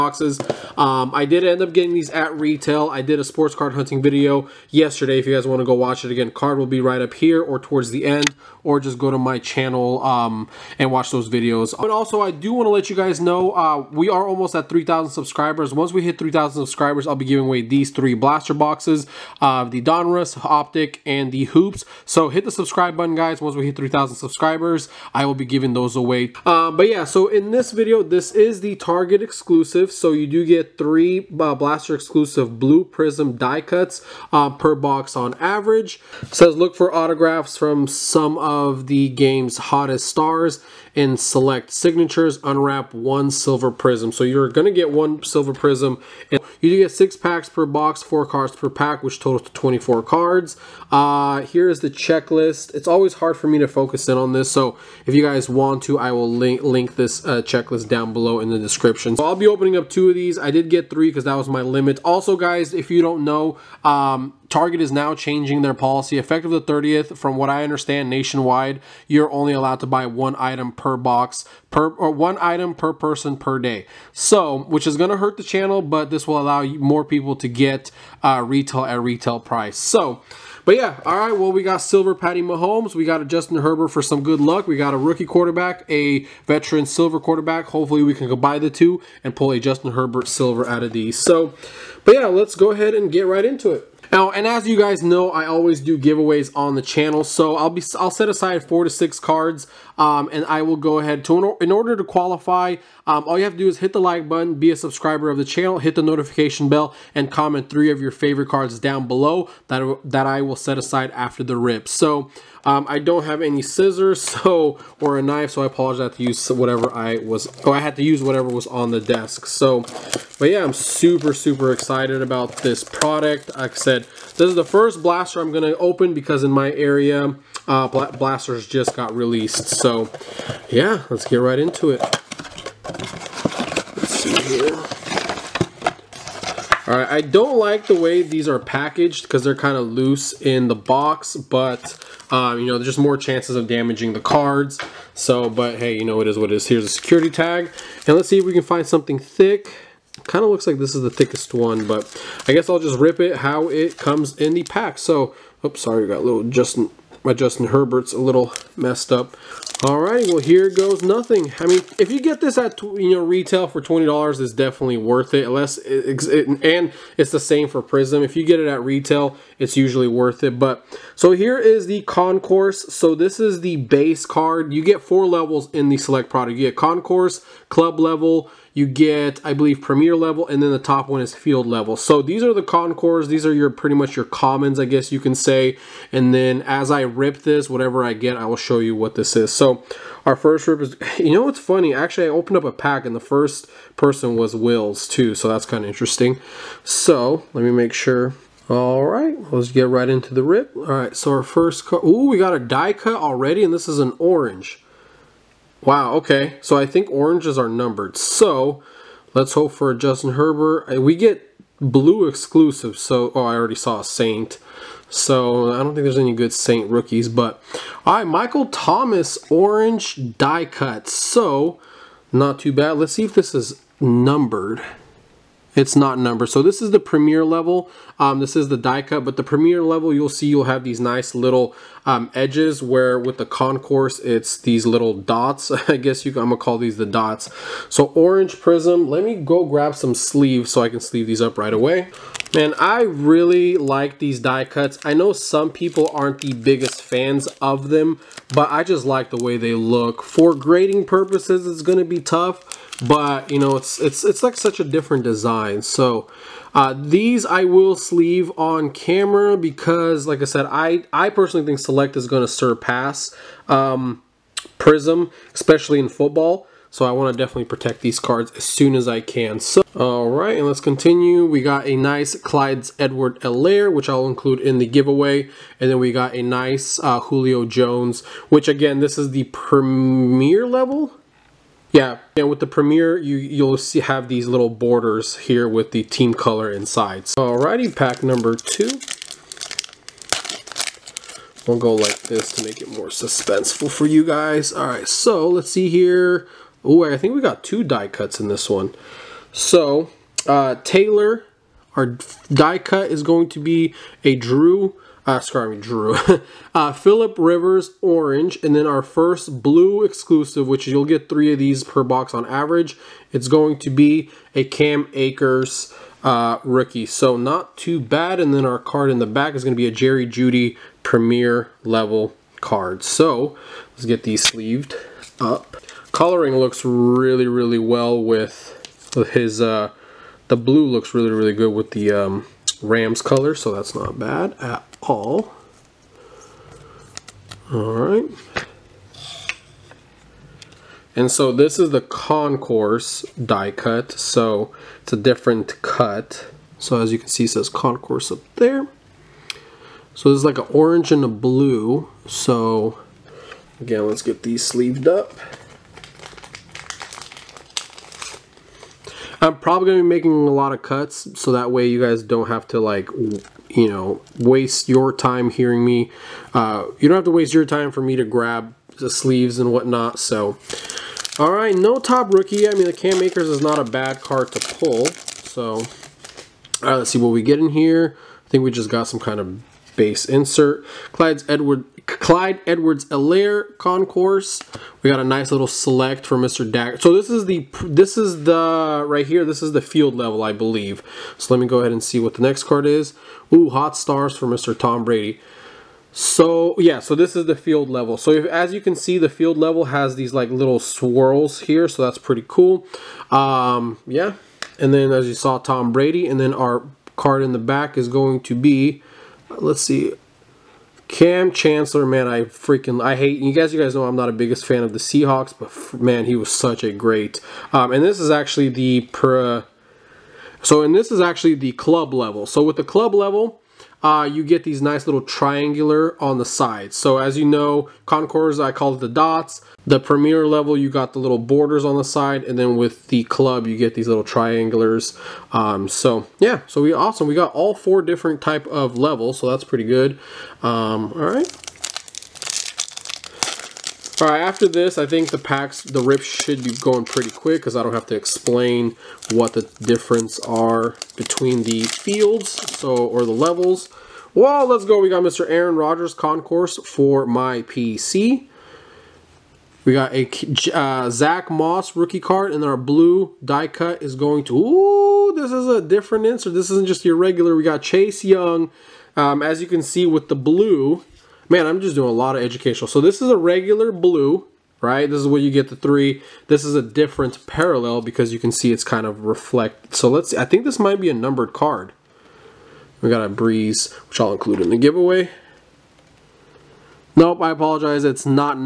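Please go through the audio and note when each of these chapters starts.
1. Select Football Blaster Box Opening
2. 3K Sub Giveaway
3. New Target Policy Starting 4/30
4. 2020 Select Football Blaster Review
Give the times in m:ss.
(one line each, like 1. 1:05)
1. 1:31
2. 0:11
3. 1:01
4. 0:27.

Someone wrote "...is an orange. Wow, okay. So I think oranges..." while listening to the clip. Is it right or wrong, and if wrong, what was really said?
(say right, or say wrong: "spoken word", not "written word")
right.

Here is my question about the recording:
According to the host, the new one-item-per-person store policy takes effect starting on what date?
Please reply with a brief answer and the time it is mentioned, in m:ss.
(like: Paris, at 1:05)
the 30th, at 1:06.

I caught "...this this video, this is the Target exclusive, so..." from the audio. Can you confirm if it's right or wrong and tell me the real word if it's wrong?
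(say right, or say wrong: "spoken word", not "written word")
right.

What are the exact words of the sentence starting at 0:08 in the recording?
Or just go to my channel um, and watch those videos.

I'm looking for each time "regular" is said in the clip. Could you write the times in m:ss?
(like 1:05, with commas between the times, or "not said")
7:47, 7:53.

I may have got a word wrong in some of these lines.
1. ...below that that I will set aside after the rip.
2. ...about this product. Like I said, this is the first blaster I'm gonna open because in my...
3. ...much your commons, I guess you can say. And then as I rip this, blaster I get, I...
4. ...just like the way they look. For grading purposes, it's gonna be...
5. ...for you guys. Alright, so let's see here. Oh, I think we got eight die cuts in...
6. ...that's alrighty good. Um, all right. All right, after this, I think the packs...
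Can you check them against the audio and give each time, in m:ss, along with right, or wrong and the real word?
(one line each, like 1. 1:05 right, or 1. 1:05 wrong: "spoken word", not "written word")
1. 1:49 right
2. 2:02 right
3. 3:03 wrong: "whatever", not "blaster"
4. 4:08 right
5. 4:53 wrong: "two", not "eight"
6. 7:19 wrong: "pretty", not "alrighty".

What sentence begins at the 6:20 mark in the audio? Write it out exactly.
Insert Clyde's Edward Clyde Edwards-Helaire concourse.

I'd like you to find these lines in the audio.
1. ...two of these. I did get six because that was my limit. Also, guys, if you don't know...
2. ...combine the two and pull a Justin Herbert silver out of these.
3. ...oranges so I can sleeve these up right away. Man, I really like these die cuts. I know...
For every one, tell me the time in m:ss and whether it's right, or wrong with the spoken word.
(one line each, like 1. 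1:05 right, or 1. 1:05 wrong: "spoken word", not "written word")
1. 0:59 wrong: "three", not "six"
2. 1:28 right
3. 4:00 wrong: "sleeves", not "oranges".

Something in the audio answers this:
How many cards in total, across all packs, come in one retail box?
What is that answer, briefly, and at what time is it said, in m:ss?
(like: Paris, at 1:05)
24, at 0:49.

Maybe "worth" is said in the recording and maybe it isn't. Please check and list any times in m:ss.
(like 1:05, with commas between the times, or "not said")
2:44, 2:50.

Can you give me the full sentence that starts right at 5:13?
It's going to be a Cam Akers uh, rookie, so not too bad.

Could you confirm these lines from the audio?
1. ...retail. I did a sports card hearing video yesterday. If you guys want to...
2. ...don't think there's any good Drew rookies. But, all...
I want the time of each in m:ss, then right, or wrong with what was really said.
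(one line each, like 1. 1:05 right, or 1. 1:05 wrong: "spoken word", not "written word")
1. 0:02 wrong: "hunting", not "hearing"
2. 3:35 wrong: "Saint", not "Drew".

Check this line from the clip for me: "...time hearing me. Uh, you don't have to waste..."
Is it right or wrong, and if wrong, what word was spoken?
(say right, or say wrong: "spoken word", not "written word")
right.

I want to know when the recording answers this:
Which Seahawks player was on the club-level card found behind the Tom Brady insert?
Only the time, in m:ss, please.
6:51.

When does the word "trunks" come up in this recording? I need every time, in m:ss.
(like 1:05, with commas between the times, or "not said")
not said.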